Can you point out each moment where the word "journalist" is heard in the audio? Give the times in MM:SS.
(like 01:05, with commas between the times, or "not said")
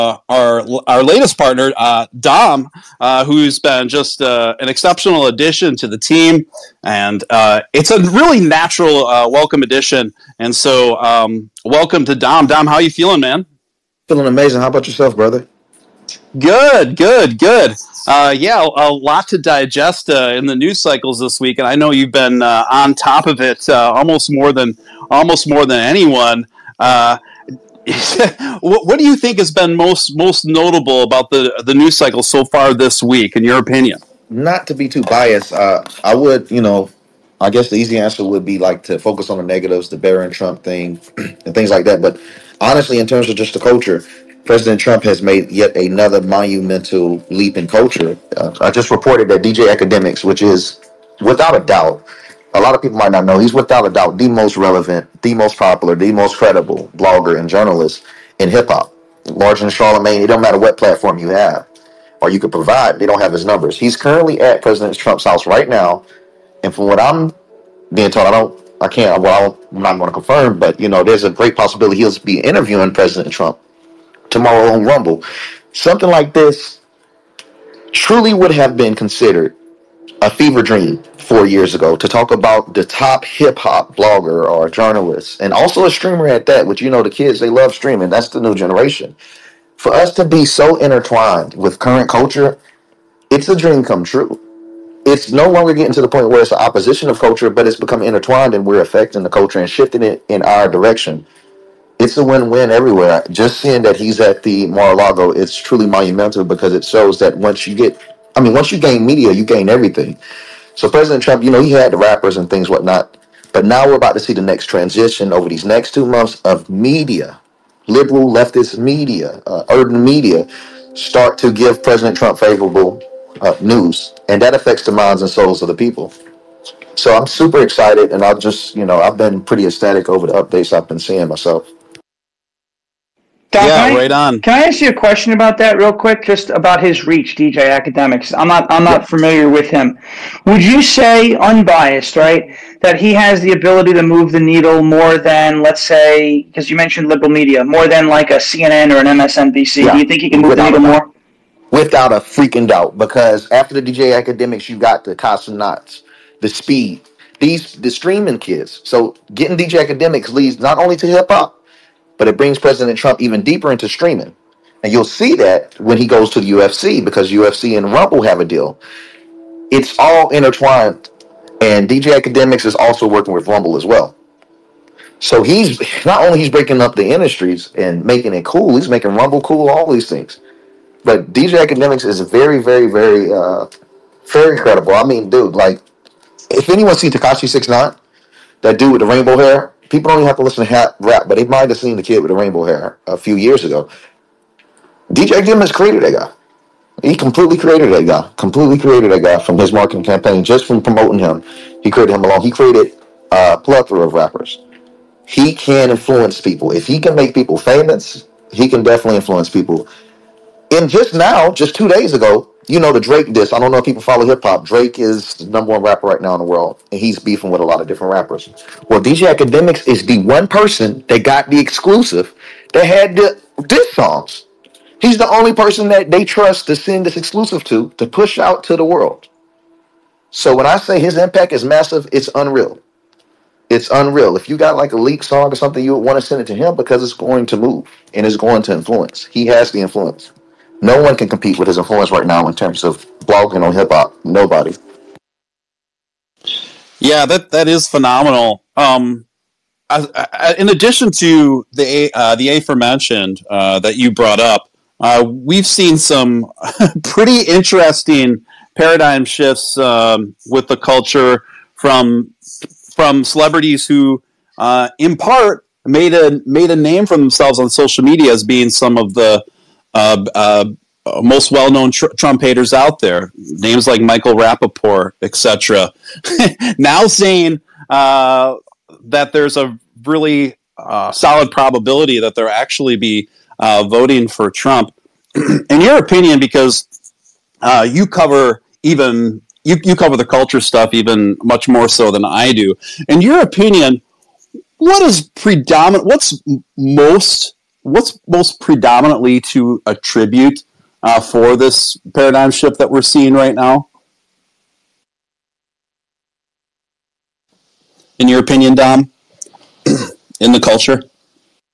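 00:57, 01:24.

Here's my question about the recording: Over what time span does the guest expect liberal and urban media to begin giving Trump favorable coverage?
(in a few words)
2 months.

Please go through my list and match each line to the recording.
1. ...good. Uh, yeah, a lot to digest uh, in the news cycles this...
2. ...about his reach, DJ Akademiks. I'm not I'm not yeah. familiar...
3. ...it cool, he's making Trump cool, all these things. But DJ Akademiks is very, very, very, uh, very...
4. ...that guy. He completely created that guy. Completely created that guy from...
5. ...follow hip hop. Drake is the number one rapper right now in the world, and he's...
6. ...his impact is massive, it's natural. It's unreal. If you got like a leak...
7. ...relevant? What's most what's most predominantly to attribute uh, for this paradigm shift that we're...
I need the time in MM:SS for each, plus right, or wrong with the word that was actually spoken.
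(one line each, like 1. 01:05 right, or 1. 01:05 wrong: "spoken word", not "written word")
1. 00:17 right
2. 02:16 right
3. 02:58 wrong: "Rumble", not "Trump"
4. 03:16 right
5. 03:34 right
6. 03:50 wrong: "unreal", not "natural"
7. 04:55 wrong: "predominant", not "relevant".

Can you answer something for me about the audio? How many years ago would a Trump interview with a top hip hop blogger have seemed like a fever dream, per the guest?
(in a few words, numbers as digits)
4.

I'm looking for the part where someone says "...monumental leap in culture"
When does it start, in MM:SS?
00:46.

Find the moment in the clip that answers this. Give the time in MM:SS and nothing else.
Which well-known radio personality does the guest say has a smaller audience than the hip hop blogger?
00:59.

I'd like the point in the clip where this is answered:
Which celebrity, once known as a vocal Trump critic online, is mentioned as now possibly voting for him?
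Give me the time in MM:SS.
04:34.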